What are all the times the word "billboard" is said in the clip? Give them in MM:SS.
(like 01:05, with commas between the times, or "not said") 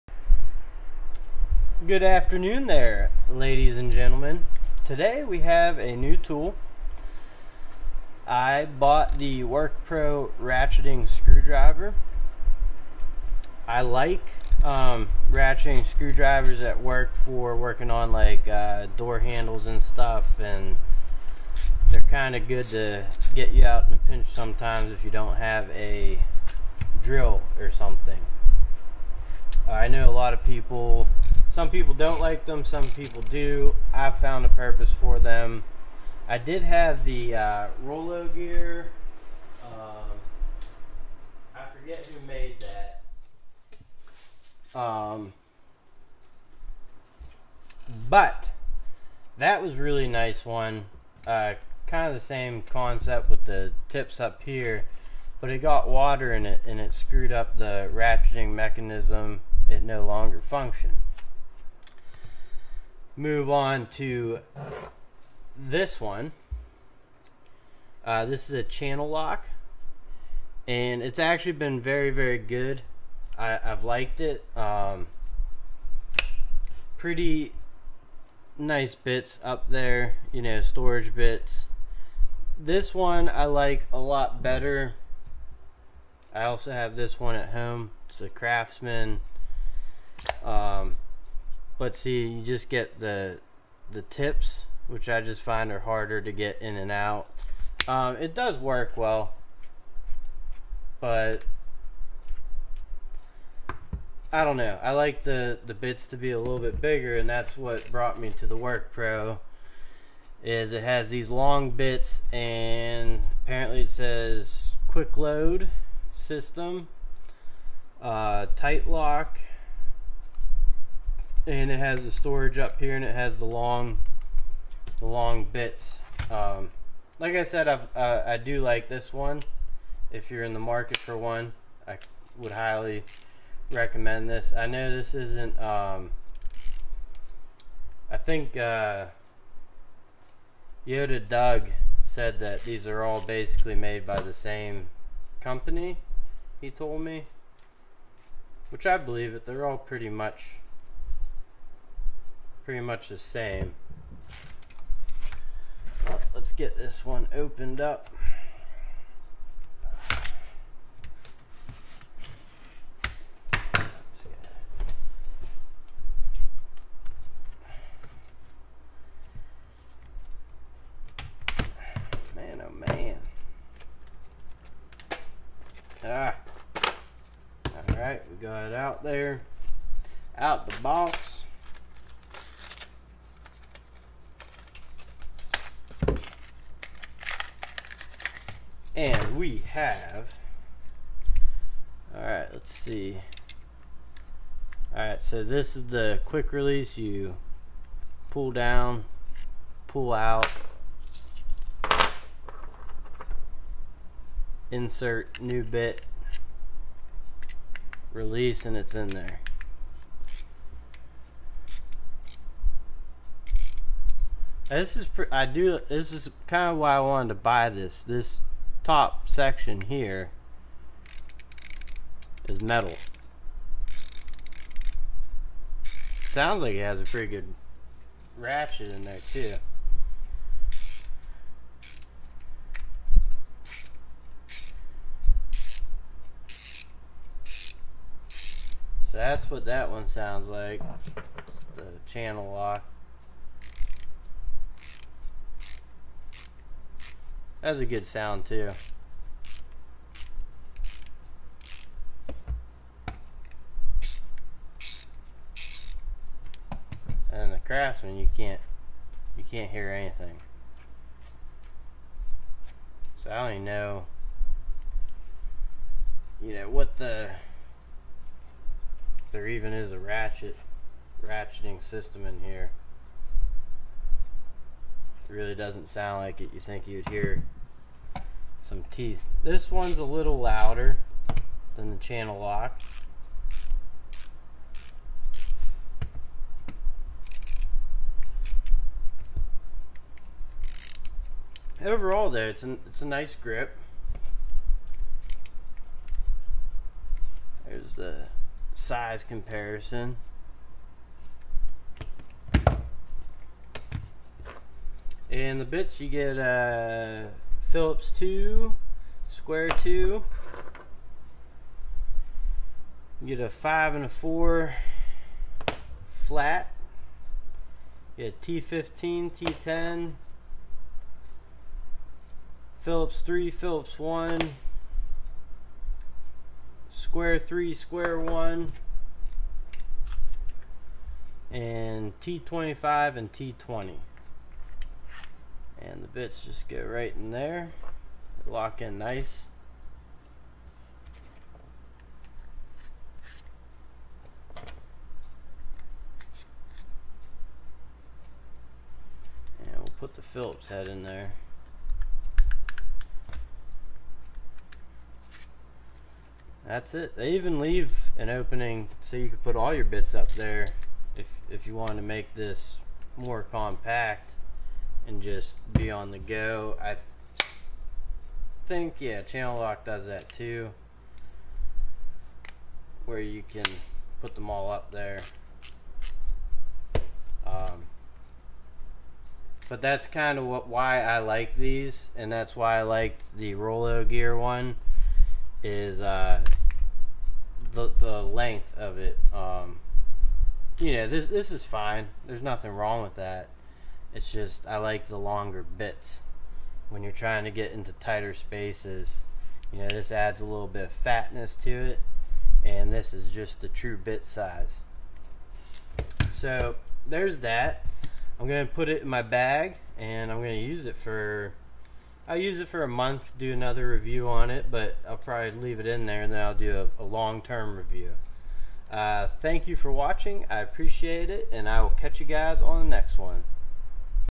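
not said.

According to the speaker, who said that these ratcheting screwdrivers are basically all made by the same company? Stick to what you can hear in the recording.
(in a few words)
Yoda Doug.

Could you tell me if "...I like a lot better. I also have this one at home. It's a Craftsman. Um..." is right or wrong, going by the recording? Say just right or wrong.
right.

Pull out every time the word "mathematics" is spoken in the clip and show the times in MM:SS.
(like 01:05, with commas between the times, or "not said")
not said.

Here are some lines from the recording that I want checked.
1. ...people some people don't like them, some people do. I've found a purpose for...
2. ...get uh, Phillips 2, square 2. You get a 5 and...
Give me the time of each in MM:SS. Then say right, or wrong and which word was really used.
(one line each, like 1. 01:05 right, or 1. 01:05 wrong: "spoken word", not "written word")
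1. 00:30 right
2. 05:06 right.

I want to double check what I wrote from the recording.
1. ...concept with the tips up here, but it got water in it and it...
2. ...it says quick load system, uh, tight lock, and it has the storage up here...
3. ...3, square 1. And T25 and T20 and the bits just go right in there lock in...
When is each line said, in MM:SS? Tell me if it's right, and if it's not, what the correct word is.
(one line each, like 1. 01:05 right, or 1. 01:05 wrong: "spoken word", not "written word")
1. 00:52 right
2. 01:53 right
3. 05:27 right.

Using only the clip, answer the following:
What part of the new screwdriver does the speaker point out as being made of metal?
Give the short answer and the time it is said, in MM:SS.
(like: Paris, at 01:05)
top section, at 03:38.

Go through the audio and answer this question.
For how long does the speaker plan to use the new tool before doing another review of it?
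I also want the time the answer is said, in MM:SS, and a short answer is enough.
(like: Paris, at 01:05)
a month, at 06:52.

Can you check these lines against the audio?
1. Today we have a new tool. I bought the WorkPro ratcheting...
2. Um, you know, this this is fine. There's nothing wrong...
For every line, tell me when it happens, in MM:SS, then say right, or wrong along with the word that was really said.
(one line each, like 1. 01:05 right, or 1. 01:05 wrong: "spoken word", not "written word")
1. 00:04 right
2. 06:29 right.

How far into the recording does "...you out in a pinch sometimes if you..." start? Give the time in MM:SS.
00:23.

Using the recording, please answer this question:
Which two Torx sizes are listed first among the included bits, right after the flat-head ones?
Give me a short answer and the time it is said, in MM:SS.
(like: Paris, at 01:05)
T15 and T10, at 05:18.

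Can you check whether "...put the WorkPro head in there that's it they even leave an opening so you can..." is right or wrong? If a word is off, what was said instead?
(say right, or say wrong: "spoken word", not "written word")
wrong: "Phillips", not "WorkPro".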